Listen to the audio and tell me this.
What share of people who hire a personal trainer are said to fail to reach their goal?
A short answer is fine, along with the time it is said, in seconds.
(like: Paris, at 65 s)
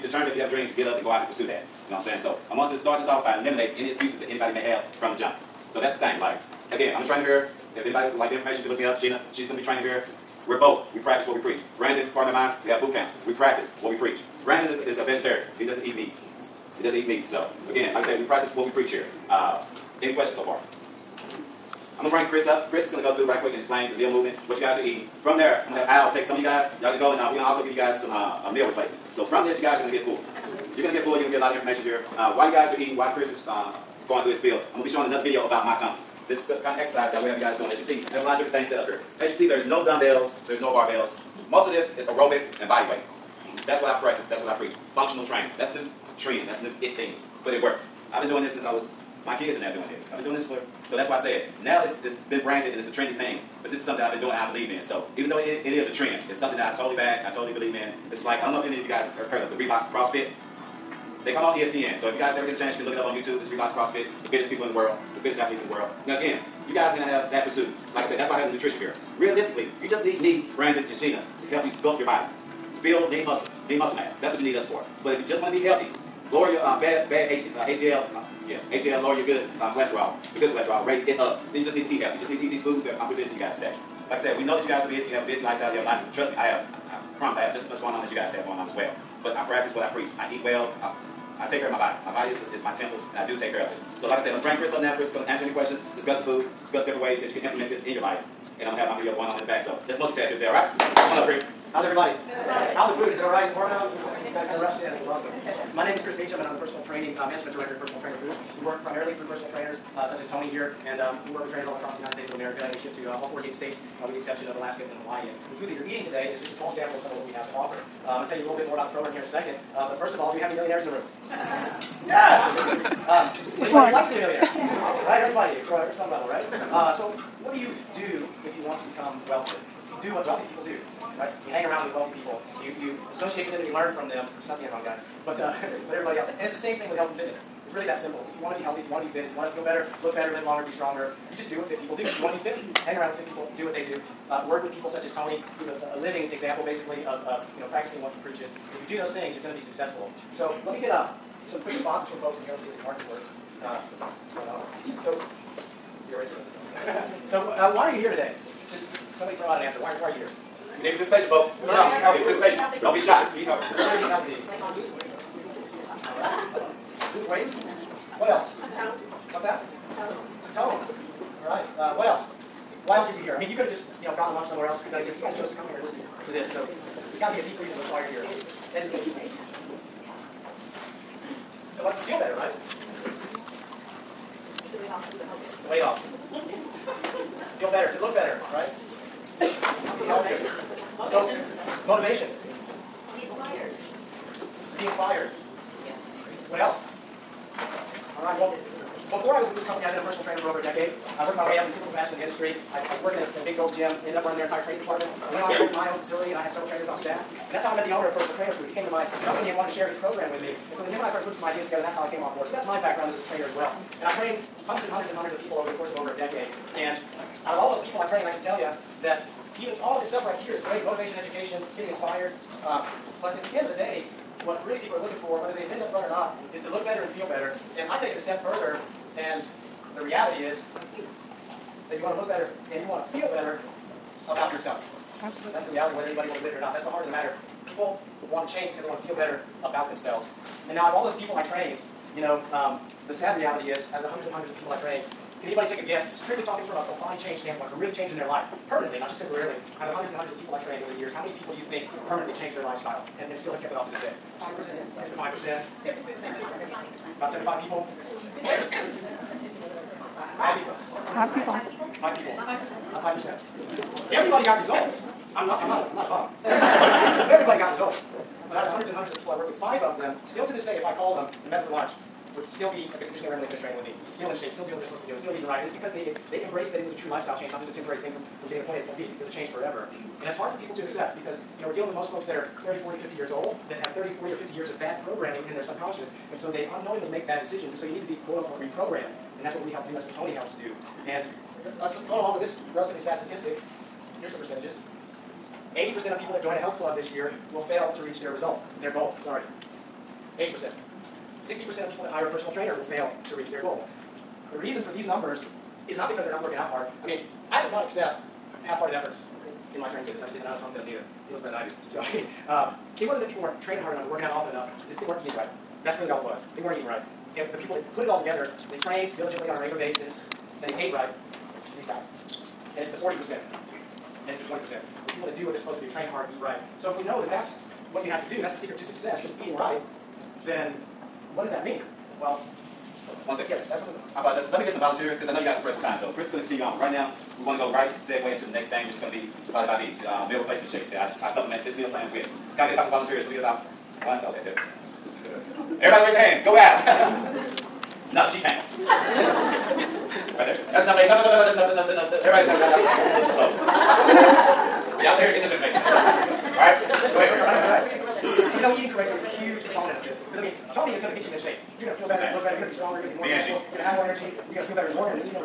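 60%, at 301 s.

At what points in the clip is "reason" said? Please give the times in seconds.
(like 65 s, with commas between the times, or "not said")
177 s, 304 s.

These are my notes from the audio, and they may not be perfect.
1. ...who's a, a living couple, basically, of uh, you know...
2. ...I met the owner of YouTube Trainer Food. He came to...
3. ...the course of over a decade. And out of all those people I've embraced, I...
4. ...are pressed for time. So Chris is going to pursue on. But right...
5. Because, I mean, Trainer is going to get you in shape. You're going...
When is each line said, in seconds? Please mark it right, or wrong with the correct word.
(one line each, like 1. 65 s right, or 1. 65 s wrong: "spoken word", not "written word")
1. 145 s wrong: "example", not "couple"
2. 207 s wrong: "Personal", not "YouTube"
3. 215 s wrong: "trained", not "embraced"
4. 335 s wrong: "continue", not "pursue"
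5. 360 s wrong: "Tony", not "Trainer".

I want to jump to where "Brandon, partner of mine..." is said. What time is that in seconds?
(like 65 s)
11 s.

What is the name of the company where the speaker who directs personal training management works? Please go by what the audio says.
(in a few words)
Personal Trainer Foods.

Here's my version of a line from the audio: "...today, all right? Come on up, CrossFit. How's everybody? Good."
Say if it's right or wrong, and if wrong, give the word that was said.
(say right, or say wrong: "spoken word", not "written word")
wrong: "Chris", not "CrossFit".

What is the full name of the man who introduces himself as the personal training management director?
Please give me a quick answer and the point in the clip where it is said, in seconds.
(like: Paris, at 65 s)
Chris Meacham, at 106 s.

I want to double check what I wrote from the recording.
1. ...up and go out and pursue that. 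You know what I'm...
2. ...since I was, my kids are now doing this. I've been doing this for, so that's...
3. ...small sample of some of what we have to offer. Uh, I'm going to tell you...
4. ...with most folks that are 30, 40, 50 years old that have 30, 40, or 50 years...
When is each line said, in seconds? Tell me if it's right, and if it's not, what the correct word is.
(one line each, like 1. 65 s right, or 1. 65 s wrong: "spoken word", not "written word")
1. 0 s right
2. 48 s right
3. 116 s right
4. 281 s right.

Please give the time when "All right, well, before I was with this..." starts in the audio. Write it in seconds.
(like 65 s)
198 s.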